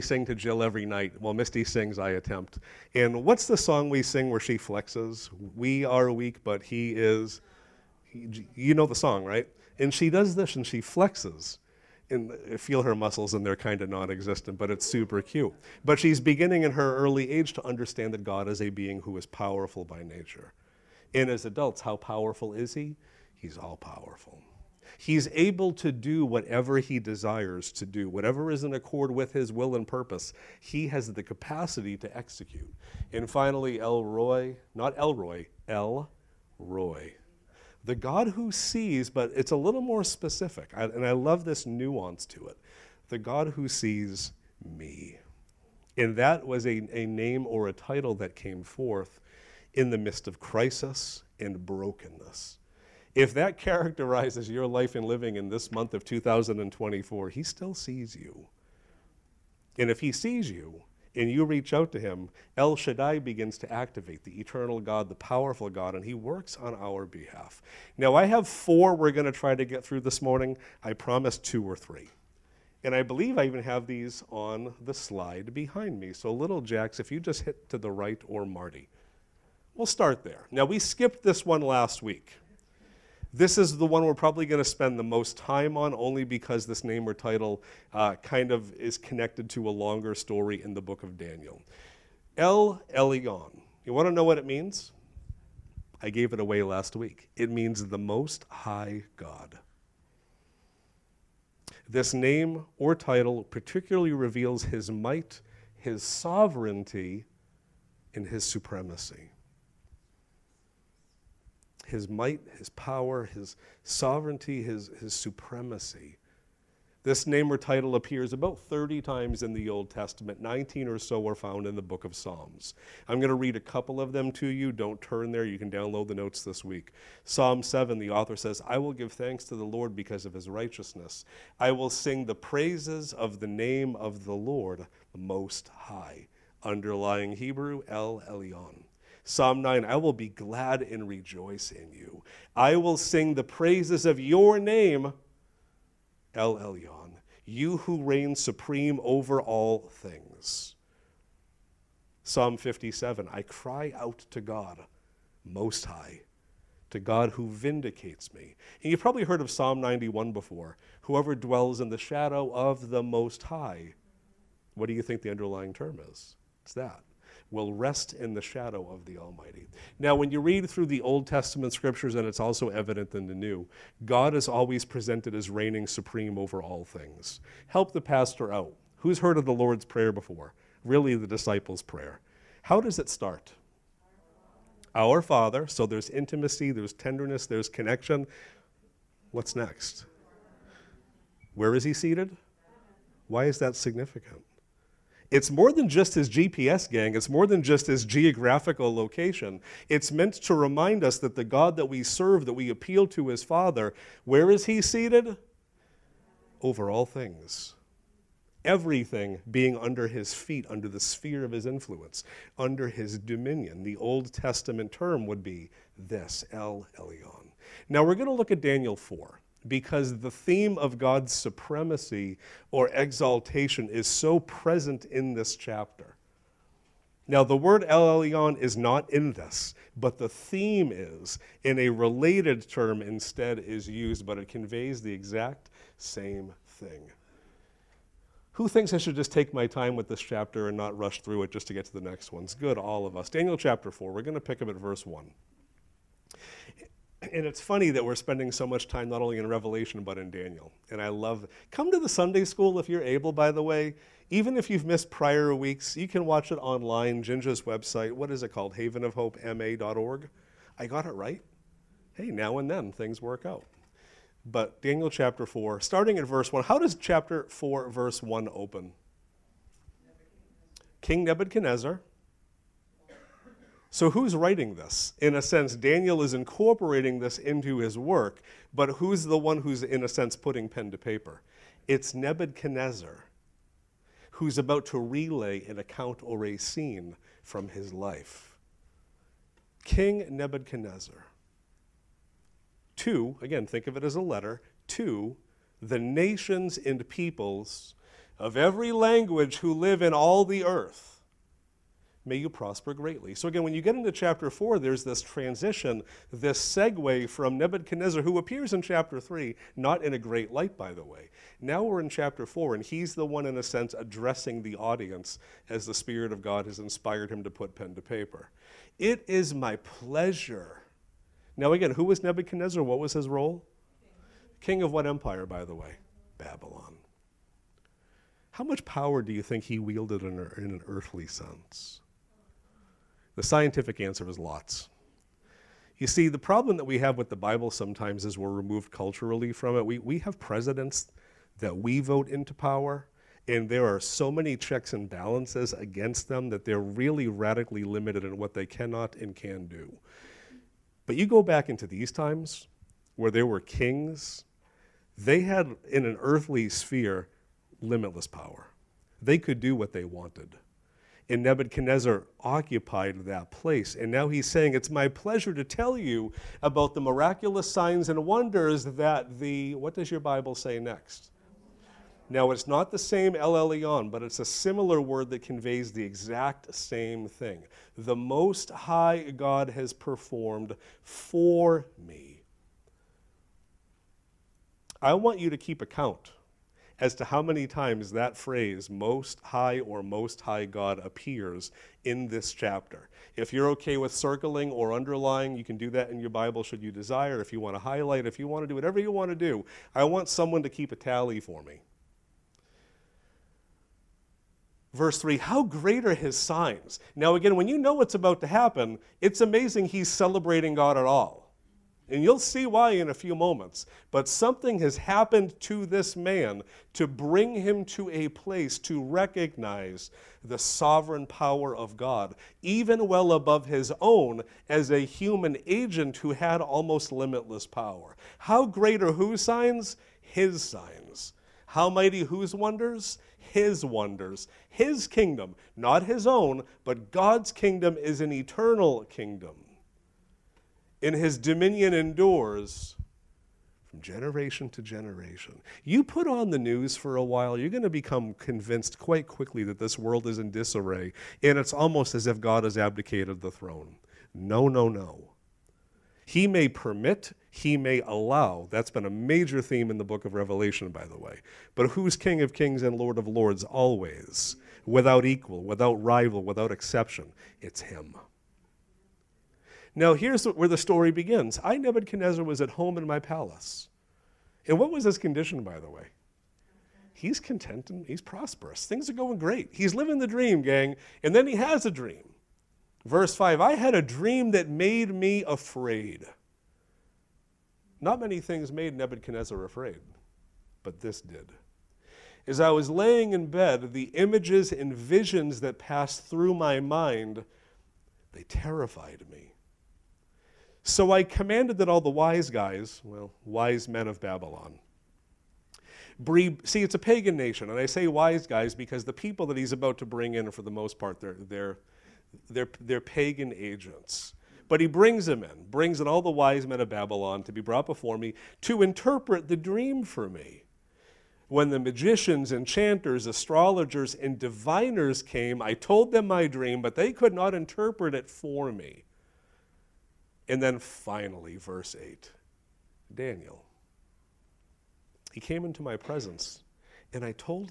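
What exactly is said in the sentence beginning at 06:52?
And you'll see why in a few moments.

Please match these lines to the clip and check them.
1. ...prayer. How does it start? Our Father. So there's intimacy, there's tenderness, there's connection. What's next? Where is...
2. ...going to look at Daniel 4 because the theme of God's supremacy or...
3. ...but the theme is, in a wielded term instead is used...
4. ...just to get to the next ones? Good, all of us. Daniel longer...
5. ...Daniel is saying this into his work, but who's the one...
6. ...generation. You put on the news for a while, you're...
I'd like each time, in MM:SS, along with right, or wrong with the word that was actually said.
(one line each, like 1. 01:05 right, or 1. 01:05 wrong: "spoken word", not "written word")
1. 03:01 right
2. 03:38 right
3. 03:49 wrong: "related", not "wielded"
4. 04:01 wrong: "chapter", not "longer"
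5. 04:35 wrong: "incorporating", not "saying"
6. 07:24 right.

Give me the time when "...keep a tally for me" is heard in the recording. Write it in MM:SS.
06:40.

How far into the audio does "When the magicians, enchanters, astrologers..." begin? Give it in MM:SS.
08:41.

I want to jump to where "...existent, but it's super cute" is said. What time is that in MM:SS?
00:14.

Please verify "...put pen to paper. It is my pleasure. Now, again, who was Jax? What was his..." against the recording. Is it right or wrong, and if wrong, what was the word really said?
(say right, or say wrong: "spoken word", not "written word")
wrong: "Nebuchadnezzar", not "Jax".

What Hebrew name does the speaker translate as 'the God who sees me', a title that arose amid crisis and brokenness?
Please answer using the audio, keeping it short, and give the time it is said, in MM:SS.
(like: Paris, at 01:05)
El Roy, at 00:35.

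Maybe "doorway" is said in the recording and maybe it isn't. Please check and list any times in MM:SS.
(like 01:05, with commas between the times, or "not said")
not said.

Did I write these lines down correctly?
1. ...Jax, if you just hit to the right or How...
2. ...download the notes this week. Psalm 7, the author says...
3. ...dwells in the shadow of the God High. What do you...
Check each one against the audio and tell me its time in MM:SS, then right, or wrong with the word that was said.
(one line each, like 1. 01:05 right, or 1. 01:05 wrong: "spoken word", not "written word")
1. 01:16 wrong: "Marty", not "How"
2. 02:05 right
3. 02:41 wrong: "Most", not "God".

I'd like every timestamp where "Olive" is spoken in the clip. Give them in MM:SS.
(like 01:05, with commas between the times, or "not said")
not said.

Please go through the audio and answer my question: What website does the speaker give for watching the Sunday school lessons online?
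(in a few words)
havenofhopema.org.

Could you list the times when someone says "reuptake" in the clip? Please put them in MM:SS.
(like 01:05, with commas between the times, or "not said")
not said.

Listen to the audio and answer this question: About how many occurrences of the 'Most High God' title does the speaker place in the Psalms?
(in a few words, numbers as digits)
19.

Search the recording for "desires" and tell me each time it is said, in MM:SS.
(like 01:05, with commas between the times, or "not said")
00:26, 06:36.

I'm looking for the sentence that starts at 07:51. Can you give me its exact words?
I, Nebuchadnezzar, was at home in my palace.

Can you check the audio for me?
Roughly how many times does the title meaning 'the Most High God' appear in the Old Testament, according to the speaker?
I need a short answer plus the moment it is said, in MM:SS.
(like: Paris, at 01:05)
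30, at 01:58.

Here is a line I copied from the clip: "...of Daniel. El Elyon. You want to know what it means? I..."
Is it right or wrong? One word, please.
right.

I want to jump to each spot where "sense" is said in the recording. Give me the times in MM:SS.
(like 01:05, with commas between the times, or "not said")
04:35, 04:40, 05:13, 05:31.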